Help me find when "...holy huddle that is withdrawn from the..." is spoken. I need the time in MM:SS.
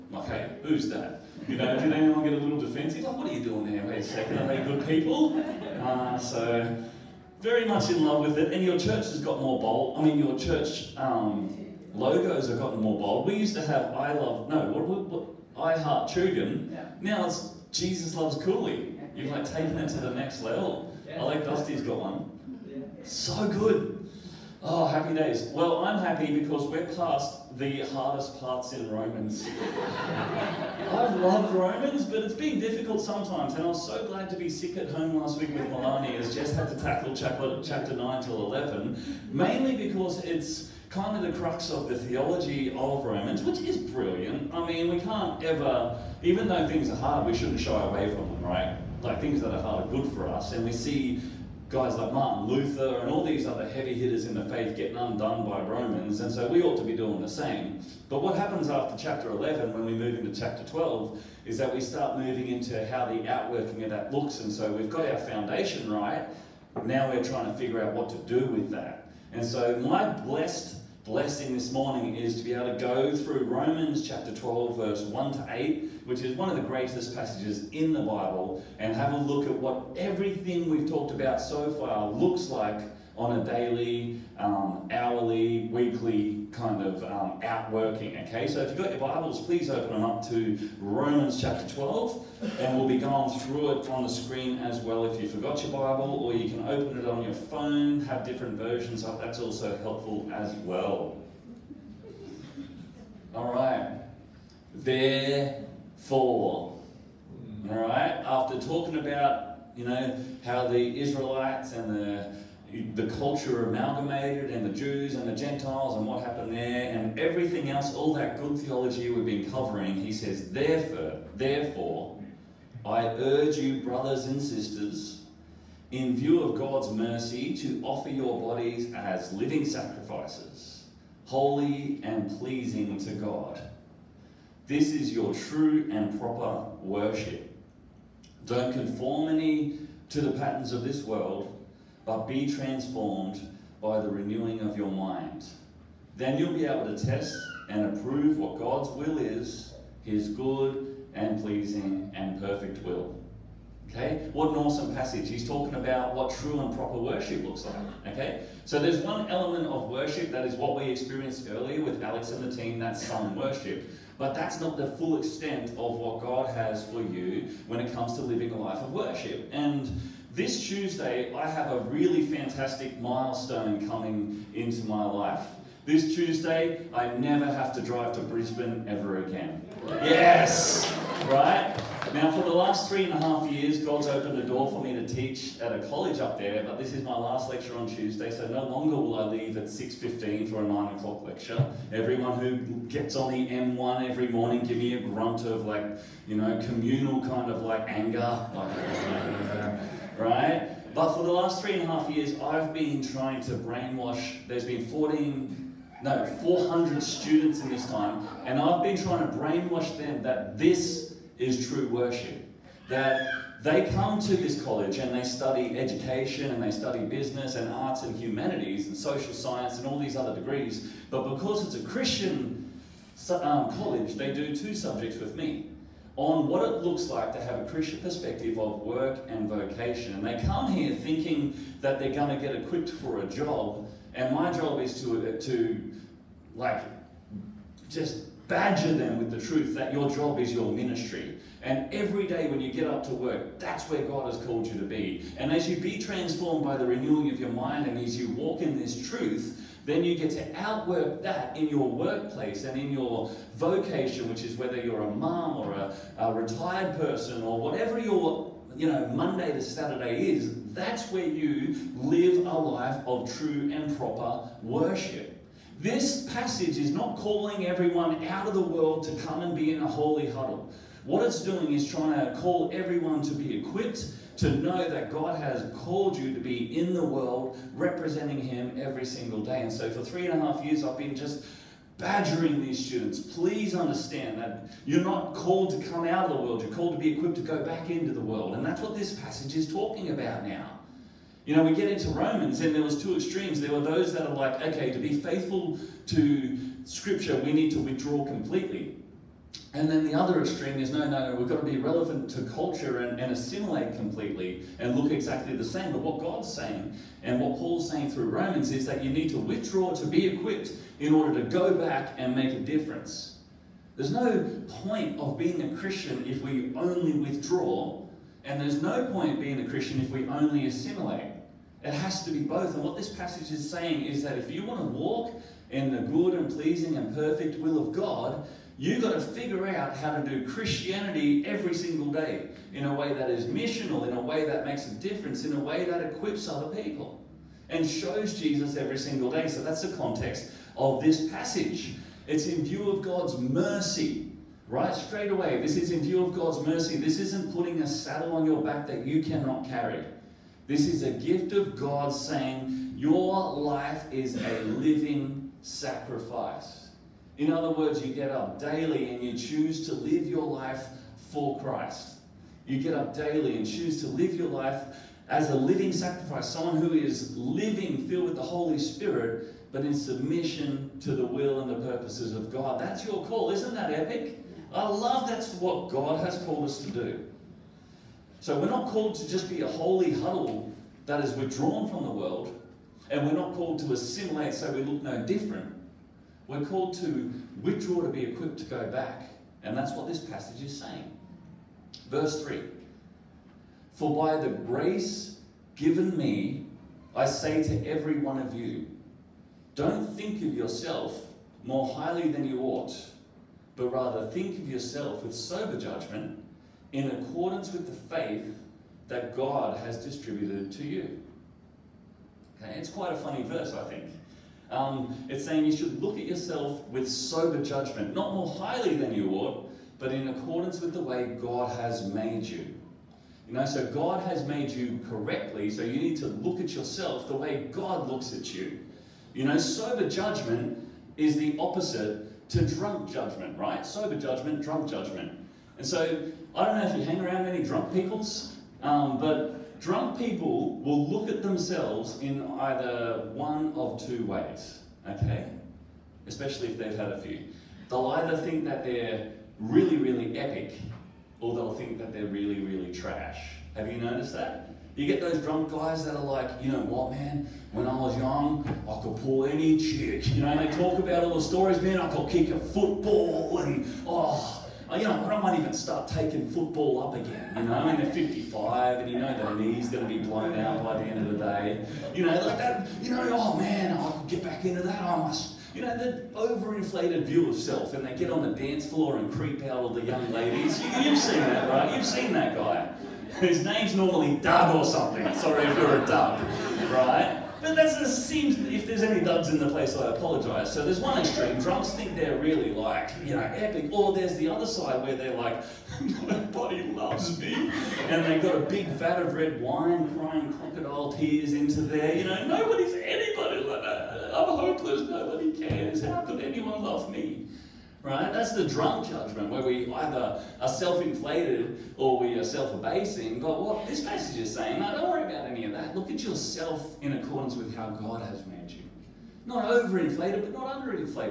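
06:19.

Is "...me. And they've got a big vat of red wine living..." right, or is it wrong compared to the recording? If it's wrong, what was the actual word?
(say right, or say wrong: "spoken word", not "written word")
wrong: "crying", not "living".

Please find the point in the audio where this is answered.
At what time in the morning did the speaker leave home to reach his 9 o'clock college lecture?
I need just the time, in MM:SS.
03:09.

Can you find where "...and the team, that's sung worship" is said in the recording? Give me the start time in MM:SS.
02:42.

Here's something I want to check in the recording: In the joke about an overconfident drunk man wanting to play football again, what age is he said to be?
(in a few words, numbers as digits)
55.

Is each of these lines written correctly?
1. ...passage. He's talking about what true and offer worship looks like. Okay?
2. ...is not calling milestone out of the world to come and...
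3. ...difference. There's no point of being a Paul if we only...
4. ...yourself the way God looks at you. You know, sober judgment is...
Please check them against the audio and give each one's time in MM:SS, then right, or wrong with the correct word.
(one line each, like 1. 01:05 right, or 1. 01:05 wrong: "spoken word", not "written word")
1. 02:34 wrong: "proper", not "offer"
2. 04:26 wrong: "everyone", not "milestone"
3. 05:12 wrong: "Christian", not "Paul"
4. 07:06 right.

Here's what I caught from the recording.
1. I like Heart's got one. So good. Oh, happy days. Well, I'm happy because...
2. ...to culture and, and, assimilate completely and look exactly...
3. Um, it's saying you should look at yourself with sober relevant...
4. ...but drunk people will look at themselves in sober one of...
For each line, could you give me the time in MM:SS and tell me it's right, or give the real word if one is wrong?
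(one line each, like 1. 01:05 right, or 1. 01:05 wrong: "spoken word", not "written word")
1. 00:21 wrong: "Dusty", not "Heart"
2. 05:02 right
3. 06:54 wrong: "judgment", not "relevant"
4. 07:19 wrong: "either", not "sober".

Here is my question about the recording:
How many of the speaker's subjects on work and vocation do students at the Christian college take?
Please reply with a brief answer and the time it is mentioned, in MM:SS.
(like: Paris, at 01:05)
2, at 03:44.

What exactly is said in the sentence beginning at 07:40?
You know, they talk about all the stories, man.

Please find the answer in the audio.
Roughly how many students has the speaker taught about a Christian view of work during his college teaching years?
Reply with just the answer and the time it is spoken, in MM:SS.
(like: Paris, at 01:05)
400, at 03:26.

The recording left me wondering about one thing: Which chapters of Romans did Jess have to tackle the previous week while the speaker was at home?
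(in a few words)
9 till 11.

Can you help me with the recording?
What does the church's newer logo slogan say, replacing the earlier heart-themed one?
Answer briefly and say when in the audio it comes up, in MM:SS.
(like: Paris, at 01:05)
Jesus Loves Cooley, at 00:17.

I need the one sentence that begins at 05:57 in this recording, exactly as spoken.
In other words, you get up daily and you choose to live your life for Christ.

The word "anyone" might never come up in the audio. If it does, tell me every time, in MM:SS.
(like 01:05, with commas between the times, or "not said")
00:01, 08:26.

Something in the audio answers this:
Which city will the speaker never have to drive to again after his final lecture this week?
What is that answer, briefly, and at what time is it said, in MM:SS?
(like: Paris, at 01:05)
Brisbane, at 02:58.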